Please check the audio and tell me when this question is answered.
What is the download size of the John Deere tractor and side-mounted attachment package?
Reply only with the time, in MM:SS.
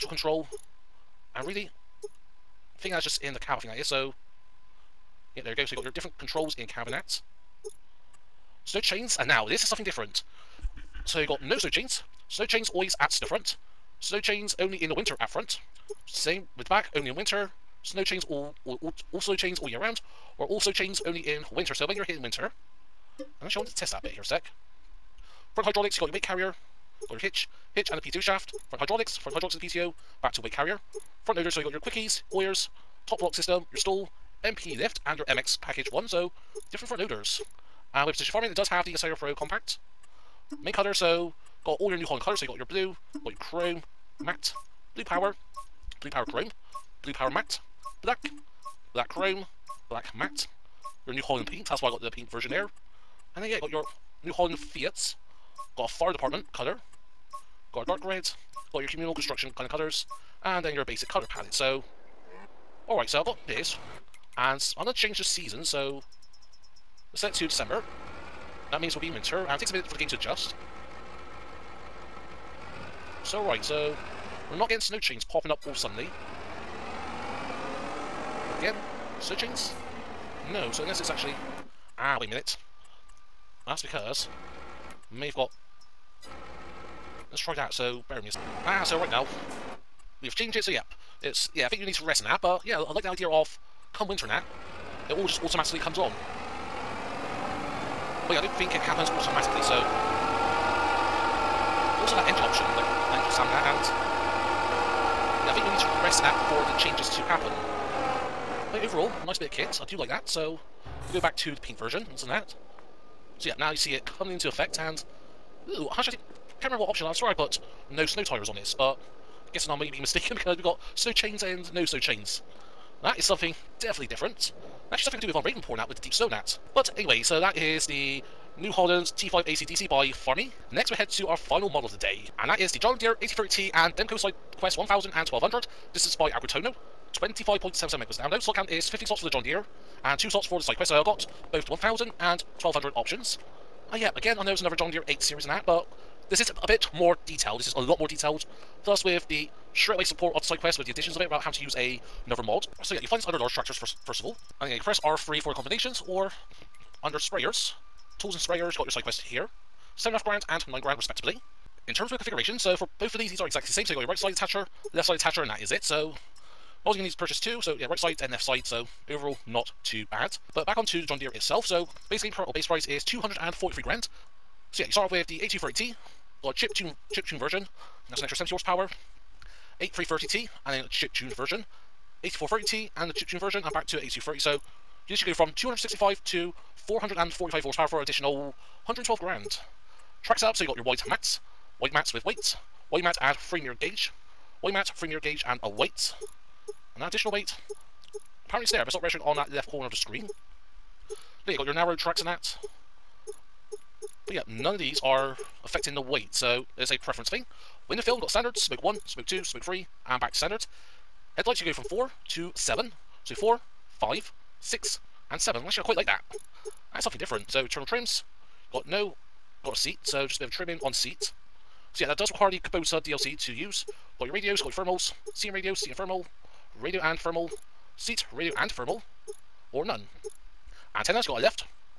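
02:17.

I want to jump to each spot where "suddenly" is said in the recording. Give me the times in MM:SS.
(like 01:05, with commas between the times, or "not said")
01:15.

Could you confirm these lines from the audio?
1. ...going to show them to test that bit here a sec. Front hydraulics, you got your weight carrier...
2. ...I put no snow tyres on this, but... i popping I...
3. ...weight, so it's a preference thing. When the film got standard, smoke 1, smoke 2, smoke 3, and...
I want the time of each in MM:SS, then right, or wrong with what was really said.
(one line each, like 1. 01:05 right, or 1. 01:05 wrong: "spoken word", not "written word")
1. 00:23 right
2. 01:57 wrong: "guessing", not "popping"
3. 03:25 right.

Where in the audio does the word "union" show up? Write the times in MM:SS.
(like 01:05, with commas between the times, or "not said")
not said.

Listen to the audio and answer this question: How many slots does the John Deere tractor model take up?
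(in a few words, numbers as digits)
15.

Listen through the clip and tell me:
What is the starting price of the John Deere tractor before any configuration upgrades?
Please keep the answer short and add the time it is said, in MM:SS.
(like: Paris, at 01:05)
243 grand, at 02:53.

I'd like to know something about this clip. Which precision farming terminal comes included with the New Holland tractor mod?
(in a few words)
Isaria Pro compact.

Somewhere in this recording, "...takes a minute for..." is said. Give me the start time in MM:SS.
01:09.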